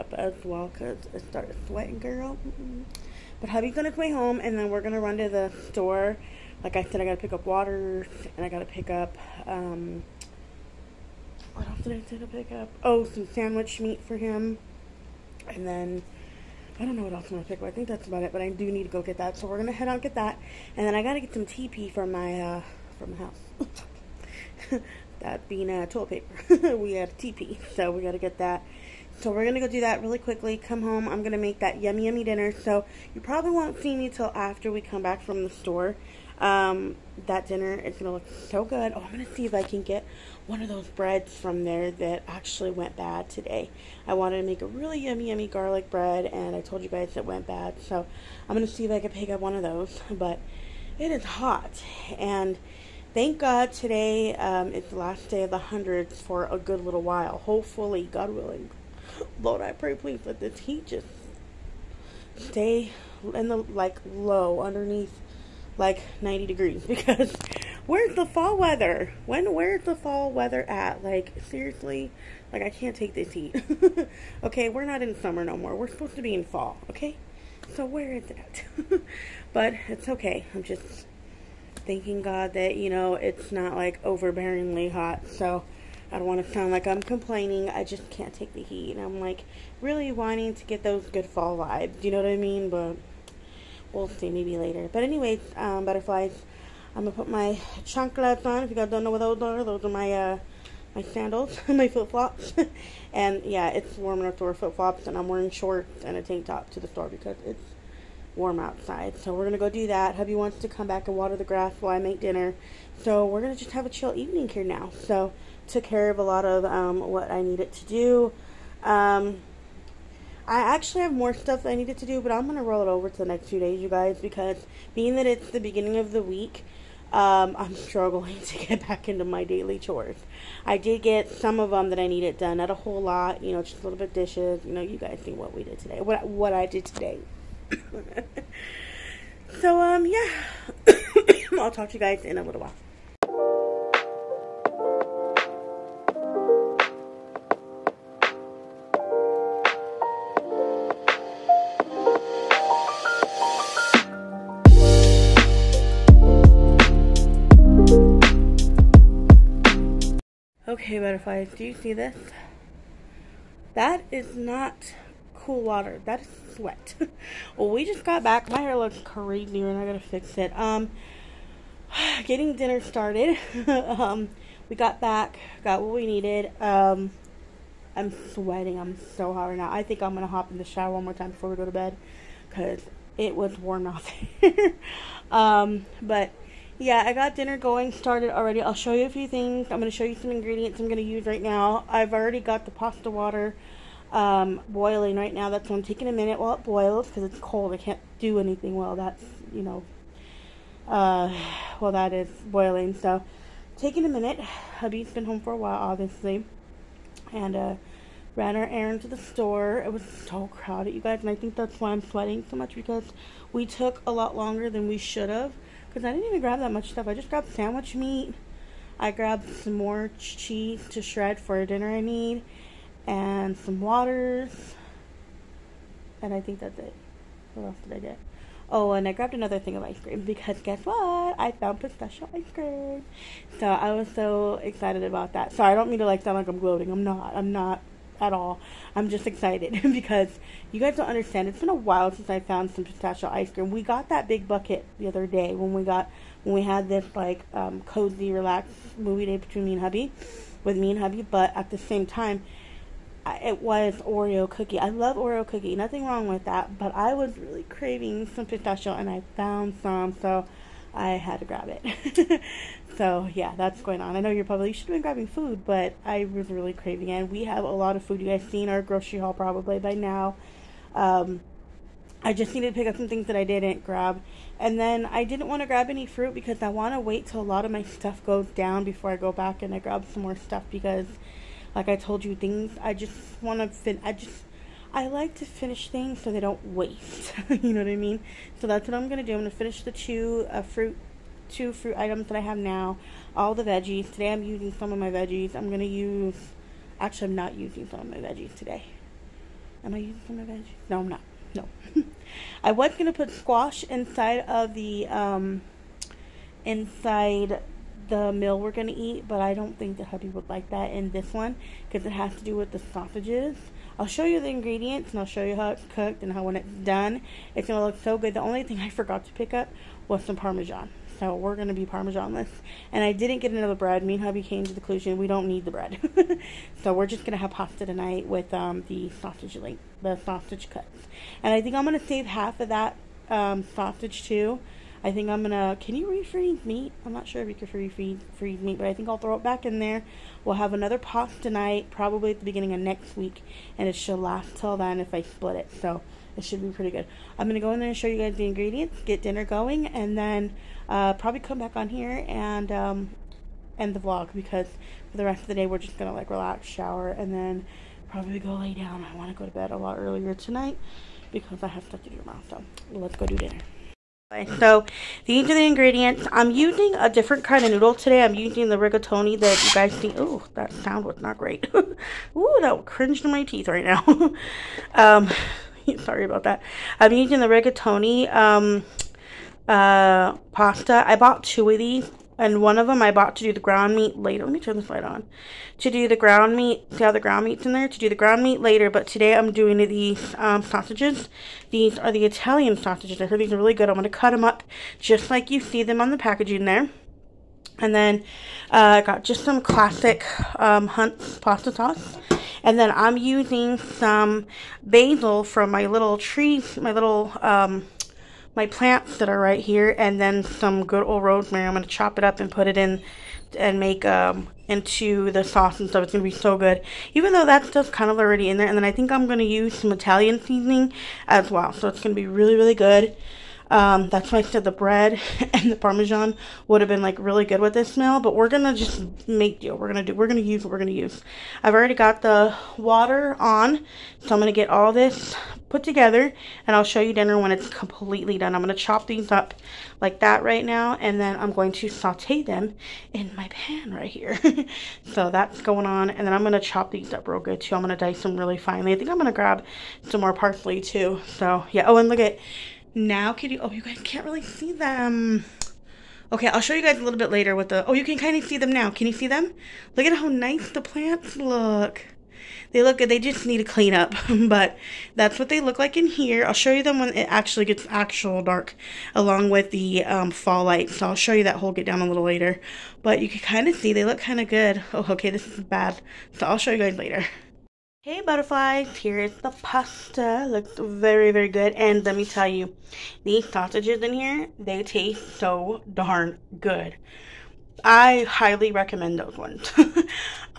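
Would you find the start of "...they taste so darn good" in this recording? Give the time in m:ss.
8:04.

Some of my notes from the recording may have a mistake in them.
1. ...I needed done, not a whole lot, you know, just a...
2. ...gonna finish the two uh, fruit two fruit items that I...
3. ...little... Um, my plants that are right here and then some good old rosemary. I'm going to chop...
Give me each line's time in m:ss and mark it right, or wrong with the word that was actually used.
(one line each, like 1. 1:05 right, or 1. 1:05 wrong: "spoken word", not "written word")
1. 2:11 right
2. 4:49 right
3. 6:46 right.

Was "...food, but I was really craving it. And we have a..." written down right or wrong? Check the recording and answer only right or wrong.
right.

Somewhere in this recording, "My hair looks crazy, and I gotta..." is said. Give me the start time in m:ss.
2:48.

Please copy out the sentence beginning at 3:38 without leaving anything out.
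I grabbed some more cheese to shred for dinner I need and some waters.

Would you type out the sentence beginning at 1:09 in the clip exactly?
When where's the fall weather at?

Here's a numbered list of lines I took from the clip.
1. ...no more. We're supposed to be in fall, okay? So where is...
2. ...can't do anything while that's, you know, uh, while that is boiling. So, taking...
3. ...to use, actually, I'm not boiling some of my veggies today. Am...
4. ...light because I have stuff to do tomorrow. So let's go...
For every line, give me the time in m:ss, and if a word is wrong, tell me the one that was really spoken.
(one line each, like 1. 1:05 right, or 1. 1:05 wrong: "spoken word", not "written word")
1. 1:15 right
2. 3:17 right
3. 4:55 wrong: "using", not "boiling"
4. 6:00 wrong: "tonight", not "light".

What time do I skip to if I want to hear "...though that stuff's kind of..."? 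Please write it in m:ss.
6:57.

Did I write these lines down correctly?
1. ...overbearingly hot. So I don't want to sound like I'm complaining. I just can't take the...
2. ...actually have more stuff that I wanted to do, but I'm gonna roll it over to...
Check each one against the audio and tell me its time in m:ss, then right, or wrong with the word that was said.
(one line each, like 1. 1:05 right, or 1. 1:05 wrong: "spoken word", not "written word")
1. 1:24 right
2. 2:00 wrong: "needed", not "wanted".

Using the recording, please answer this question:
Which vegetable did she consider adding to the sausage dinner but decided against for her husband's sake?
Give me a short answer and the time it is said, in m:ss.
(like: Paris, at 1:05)
squash, at 5:03.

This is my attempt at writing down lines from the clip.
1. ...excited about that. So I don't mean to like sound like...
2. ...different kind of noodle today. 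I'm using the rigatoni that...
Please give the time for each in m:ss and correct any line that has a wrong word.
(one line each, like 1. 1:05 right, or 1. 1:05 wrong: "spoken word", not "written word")
1. 3:54 right
2. 6:07 right.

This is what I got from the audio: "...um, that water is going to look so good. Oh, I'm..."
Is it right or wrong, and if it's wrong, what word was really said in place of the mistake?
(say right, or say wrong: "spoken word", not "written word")
wrong: "dinner", not "water".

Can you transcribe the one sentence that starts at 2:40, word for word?
Okay, butterflies, do you see this?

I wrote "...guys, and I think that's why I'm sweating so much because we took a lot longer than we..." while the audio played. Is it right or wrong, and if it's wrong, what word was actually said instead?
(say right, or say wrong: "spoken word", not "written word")
right.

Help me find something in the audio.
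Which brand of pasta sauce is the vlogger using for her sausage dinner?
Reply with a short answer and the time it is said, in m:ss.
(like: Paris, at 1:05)
Hunt's, at 6:40.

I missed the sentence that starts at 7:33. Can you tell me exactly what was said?
Oh, you guys can't really see them.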